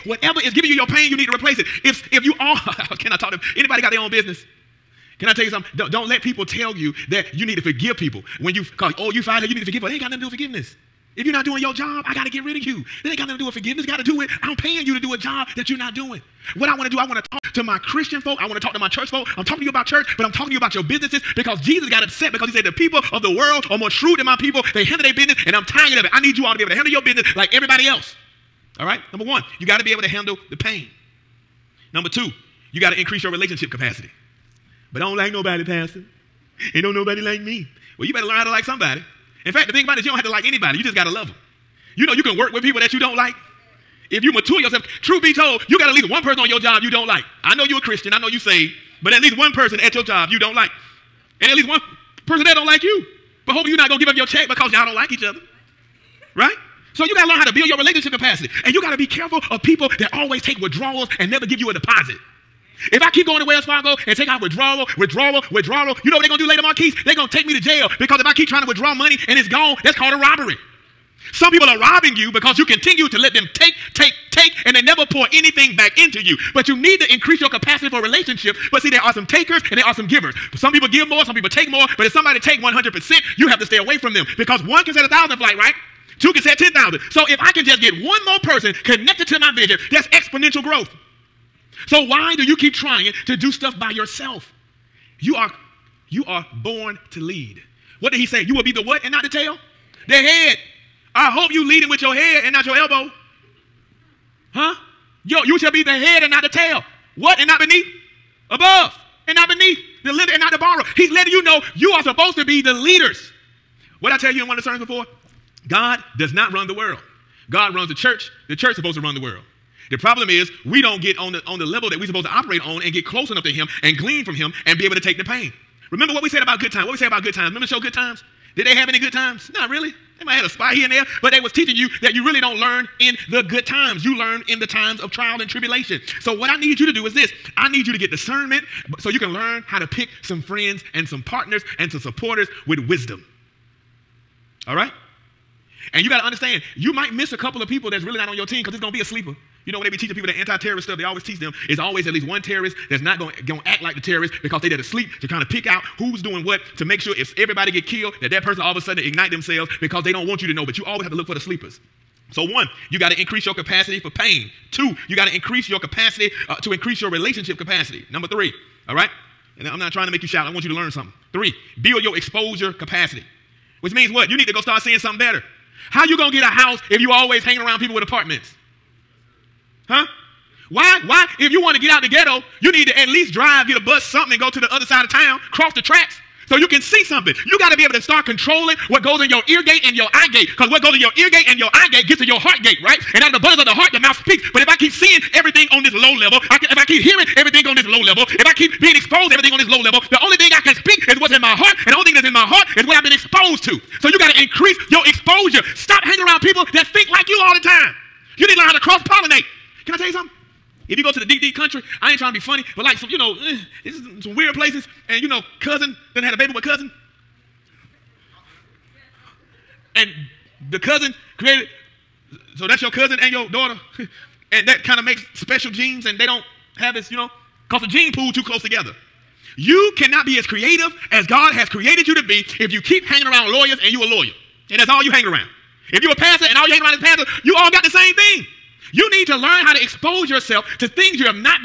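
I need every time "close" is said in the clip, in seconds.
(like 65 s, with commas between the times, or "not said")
123 s, 228 s.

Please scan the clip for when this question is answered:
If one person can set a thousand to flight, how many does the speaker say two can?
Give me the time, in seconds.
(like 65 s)
86 s.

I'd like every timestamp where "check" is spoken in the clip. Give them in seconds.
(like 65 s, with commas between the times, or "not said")
54 s.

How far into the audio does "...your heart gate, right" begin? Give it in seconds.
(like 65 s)
192 s.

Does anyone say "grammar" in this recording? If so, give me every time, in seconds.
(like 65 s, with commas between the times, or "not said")
not said.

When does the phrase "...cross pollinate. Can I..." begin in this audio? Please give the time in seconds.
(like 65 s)
208 s.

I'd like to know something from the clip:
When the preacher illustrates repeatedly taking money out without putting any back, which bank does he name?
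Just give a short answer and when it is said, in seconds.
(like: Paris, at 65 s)
Wells Fargo, at 63 s.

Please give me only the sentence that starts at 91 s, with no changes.
So why do you keep trying to do stuff by yourself?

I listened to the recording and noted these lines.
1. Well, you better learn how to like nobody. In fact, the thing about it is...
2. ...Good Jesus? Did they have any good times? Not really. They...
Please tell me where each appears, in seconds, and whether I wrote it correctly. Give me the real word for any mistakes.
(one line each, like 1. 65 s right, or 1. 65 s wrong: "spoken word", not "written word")
1. 37 s wrong: "somebody", not "nobody"
2. 127 s wrong: "Times", not "Jesus".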